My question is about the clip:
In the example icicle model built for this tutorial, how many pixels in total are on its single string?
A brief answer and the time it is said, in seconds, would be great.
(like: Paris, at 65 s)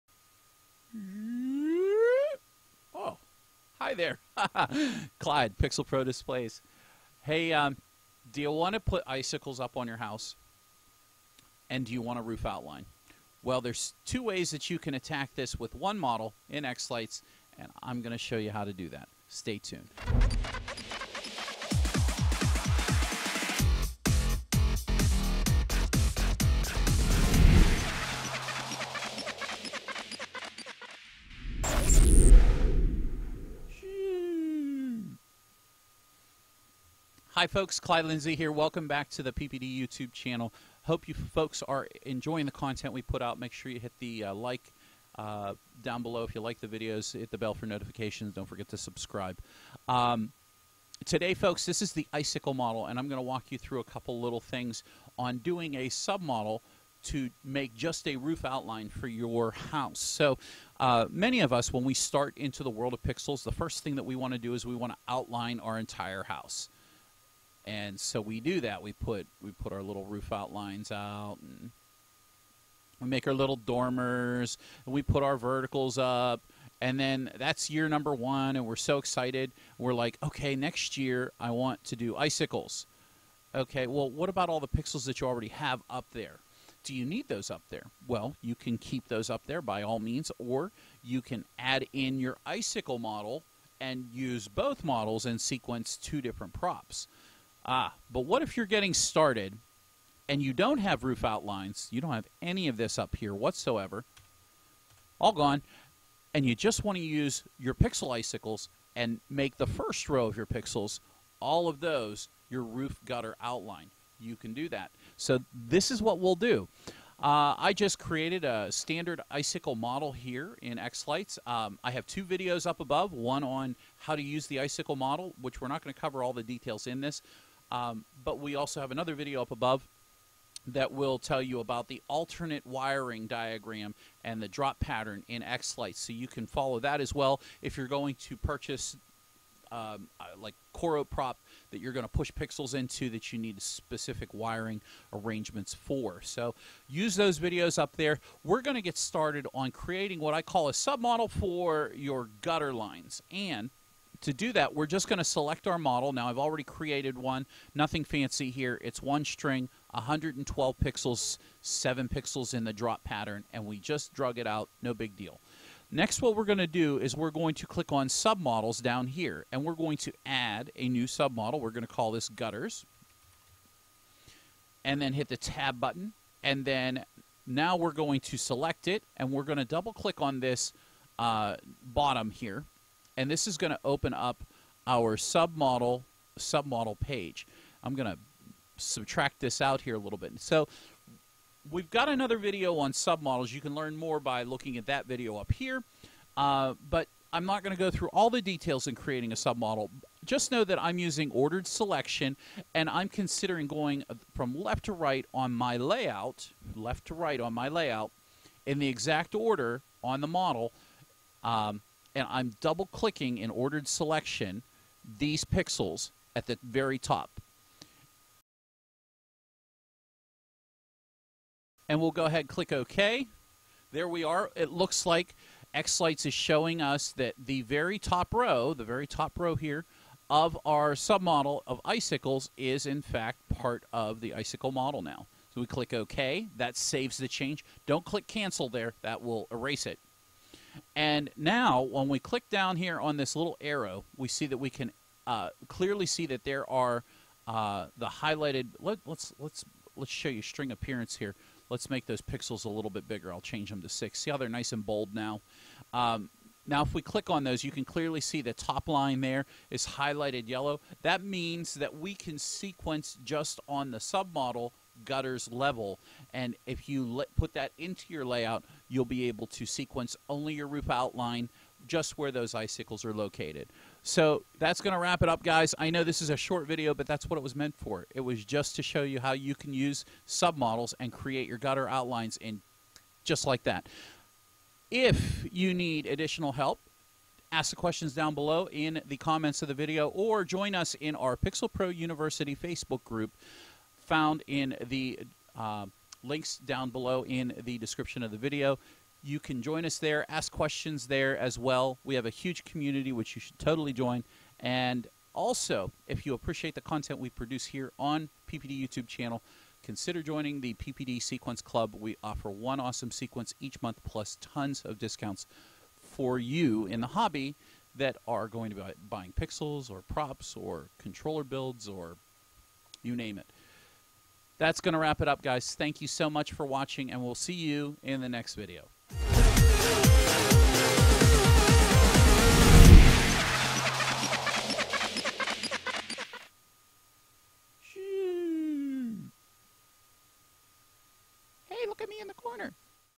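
112, at 159 s.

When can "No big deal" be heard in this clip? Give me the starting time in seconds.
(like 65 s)
164 s.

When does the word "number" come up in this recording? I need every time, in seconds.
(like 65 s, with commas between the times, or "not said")
77 s.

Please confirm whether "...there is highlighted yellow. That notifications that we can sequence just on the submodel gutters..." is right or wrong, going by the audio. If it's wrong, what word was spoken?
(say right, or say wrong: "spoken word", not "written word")
wrong: "means", not "notifications".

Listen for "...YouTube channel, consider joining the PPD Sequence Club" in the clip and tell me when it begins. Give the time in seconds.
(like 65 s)
308 s.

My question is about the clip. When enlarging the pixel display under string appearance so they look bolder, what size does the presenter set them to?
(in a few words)
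6.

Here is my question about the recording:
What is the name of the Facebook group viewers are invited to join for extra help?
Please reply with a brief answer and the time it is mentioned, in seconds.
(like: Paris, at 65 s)
Pixel Pro University, at 291 s.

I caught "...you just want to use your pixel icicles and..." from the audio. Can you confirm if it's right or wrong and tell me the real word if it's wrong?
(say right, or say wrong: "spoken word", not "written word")
right.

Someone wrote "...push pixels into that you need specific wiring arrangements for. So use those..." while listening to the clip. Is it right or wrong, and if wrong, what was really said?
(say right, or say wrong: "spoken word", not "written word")
right.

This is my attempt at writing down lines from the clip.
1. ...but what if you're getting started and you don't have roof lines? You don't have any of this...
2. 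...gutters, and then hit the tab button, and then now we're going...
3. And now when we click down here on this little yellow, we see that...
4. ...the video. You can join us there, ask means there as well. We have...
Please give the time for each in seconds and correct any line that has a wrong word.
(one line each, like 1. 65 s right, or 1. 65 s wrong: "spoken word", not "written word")
1. 98 s wrong: "outlines", not "lines"
2. 172 s right
3. 240 s wrong: "arrow", not "yellow"
4. 298 s wrong: "questions", not "means".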